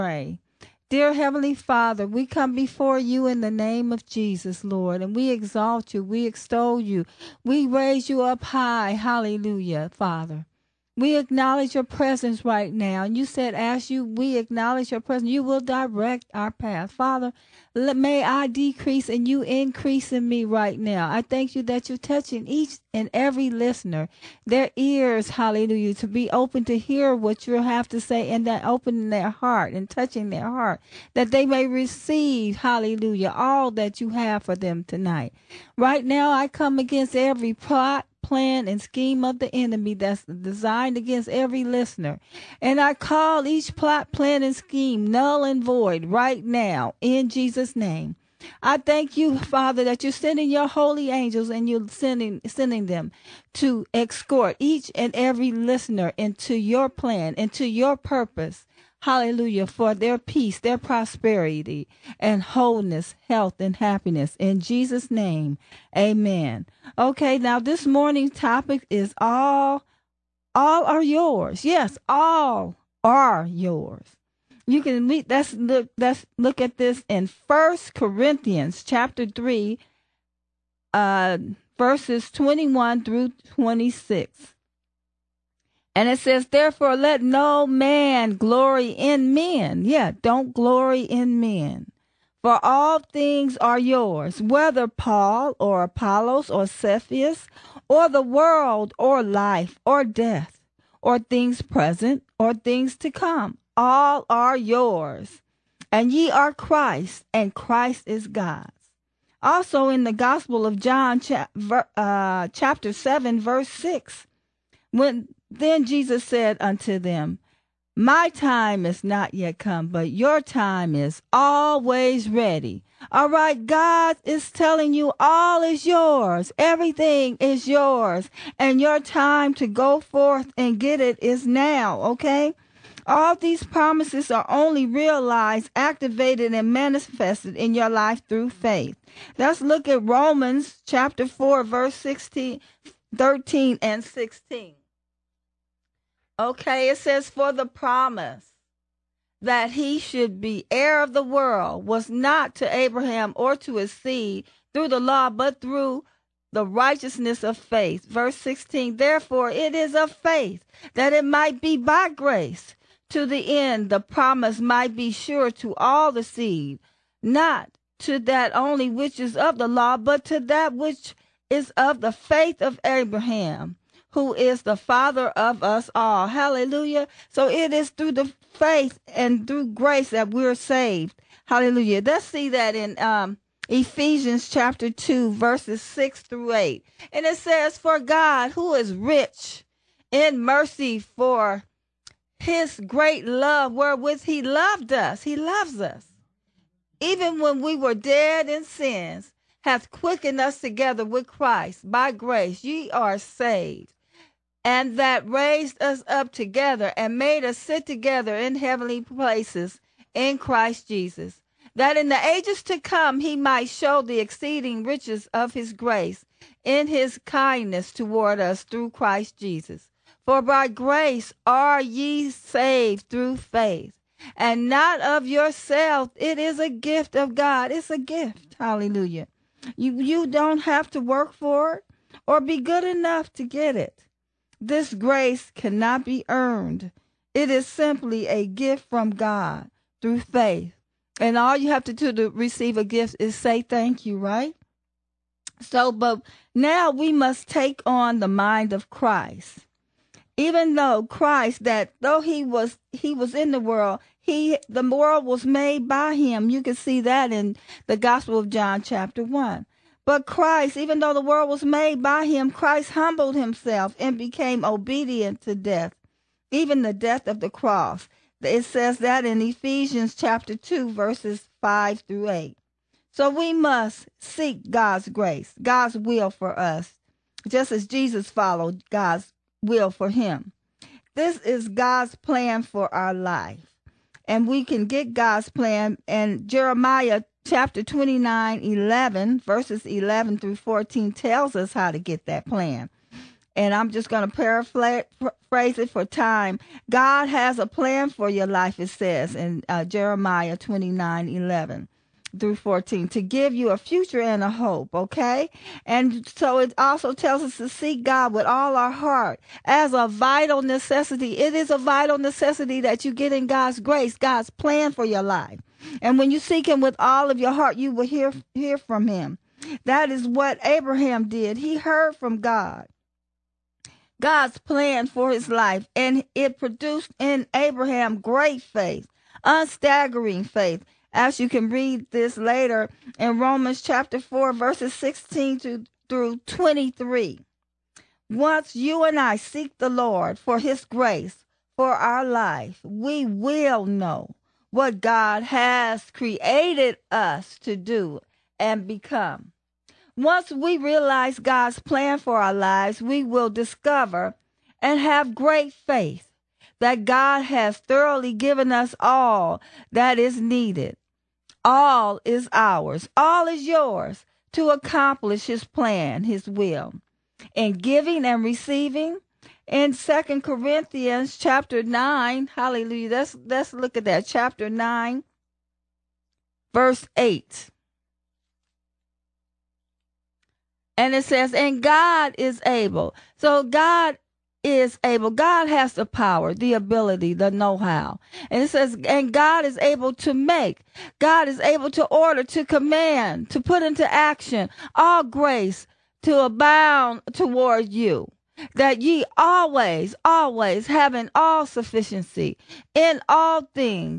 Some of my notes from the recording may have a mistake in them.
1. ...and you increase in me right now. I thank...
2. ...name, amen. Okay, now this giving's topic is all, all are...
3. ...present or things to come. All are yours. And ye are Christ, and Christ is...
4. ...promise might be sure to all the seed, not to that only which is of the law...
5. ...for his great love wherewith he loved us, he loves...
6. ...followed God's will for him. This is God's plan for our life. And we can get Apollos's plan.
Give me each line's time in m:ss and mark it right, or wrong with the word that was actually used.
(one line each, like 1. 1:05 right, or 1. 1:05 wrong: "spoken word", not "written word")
1. 0:19 right
2. 1:05 wrong: "morning", not "giving"
3. 1:41 right
4. 2:43 right
5. 3:10 right
6. 4:38 wrong: "God", not "Apollos".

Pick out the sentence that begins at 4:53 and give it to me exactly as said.
And I'm just going to paraphrase it for time.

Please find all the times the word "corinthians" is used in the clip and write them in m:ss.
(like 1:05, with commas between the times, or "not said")
1:17, 6:10.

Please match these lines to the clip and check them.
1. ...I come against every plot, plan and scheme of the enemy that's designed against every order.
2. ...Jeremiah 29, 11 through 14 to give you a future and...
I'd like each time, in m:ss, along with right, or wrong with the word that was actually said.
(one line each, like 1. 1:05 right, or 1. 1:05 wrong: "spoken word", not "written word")
1. 0:36 wrong: "listener", not "order"
2. 4:59 right.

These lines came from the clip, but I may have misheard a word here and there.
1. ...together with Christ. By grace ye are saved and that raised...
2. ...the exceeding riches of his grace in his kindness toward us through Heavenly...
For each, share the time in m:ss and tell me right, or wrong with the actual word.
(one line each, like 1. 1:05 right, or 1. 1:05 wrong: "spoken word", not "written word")
1. 3:20 right
2. 3:34 wrong: "Christ", not "Heavenly".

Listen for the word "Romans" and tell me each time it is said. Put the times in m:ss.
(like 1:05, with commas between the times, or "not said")
2:20, 5:33.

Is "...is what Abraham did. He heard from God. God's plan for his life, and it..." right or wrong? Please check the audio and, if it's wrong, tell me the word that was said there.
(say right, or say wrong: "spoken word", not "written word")
right.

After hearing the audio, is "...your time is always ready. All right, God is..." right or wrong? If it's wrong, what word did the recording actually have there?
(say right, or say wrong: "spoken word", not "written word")
right.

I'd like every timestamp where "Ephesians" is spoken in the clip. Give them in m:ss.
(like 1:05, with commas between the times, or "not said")
3:03, 4:29.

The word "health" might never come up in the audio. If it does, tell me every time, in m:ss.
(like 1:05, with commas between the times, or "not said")
1:03.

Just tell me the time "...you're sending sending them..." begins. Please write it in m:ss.
0:51.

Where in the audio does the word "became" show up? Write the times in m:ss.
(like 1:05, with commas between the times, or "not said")
4:24.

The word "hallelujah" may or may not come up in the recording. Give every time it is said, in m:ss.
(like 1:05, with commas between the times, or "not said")
0:08, 0:25, 0:32, 0:59, 2:56, 3:01, 3:48, 6:12.